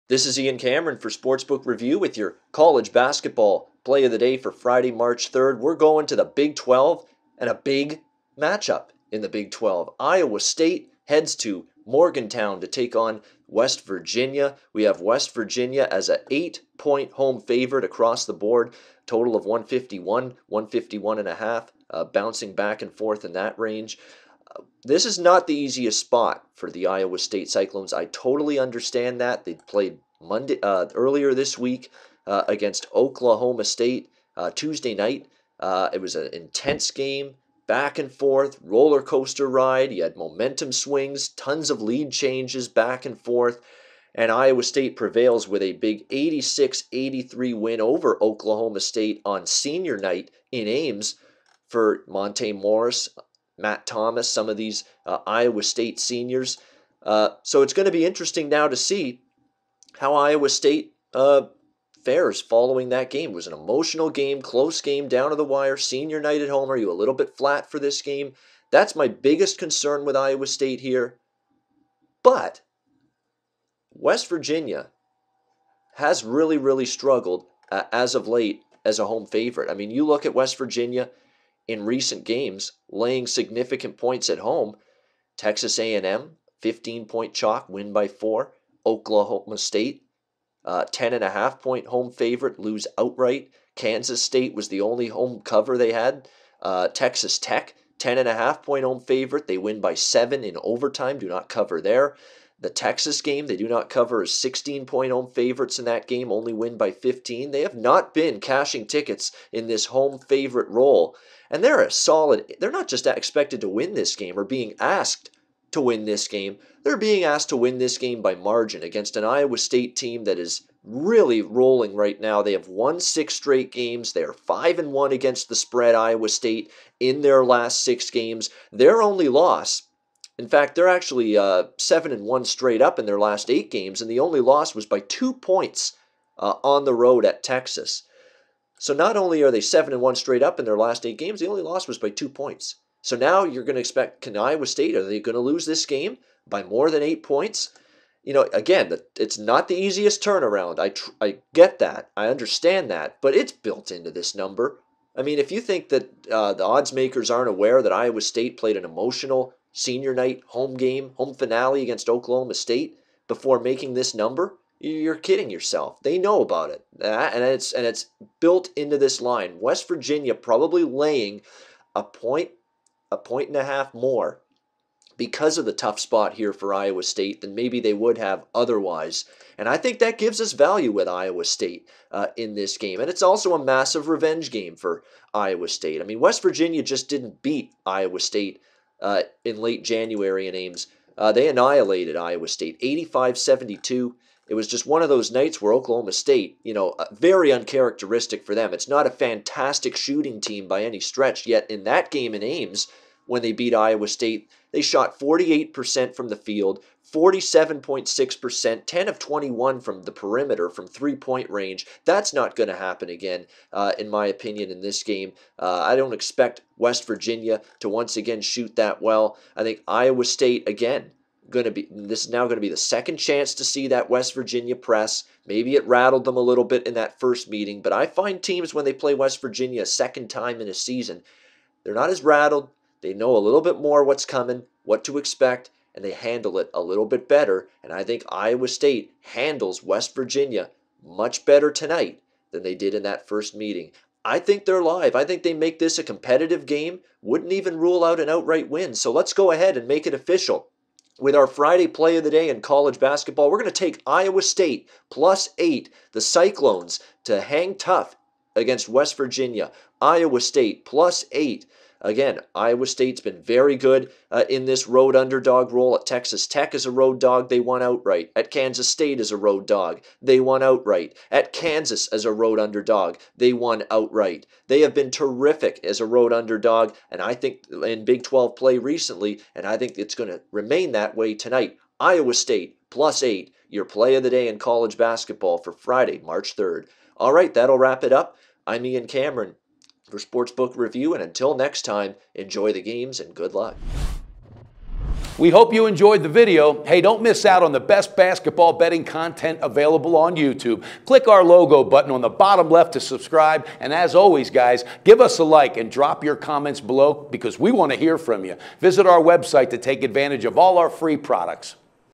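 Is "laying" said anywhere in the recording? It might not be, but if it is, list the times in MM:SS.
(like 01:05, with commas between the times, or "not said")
01:22, 02:50.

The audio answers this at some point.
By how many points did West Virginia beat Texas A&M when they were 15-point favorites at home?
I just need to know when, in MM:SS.
01:27.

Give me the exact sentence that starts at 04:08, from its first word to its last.
So let's go ahead and make it official.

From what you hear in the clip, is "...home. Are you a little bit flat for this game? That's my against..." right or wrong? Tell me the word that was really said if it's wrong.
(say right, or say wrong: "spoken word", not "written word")
wrong: "biggest", not "against".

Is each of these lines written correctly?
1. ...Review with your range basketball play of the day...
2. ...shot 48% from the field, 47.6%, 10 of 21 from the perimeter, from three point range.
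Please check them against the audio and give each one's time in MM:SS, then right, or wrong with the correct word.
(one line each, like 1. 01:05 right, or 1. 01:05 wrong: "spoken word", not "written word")
1. 00:01 wrong: "college", not "range"
2. 03:24 right.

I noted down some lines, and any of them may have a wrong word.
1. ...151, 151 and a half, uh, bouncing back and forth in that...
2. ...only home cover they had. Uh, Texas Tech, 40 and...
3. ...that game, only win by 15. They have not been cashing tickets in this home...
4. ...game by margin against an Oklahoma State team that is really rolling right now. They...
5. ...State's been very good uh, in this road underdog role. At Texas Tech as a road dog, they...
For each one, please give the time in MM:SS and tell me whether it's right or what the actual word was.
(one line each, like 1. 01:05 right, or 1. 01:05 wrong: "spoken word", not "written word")
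1. 00:19 right
2. 01:34 wrong: "10", not "40"
3. 01:45 right
4. 01:57 wrong: "Iowa", not "Oklahoma"
5. 04:22 right.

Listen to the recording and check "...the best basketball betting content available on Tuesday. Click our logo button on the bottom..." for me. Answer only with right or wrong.
wrong.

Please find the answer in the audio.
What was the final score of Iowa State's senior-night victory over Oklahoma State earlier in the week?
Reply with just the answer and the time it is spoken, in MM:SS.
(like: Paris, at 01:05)
86-83, at 00:46.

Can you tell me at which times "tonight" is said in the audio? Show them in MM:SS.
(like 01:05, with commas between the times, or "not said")
04:01, 04:41.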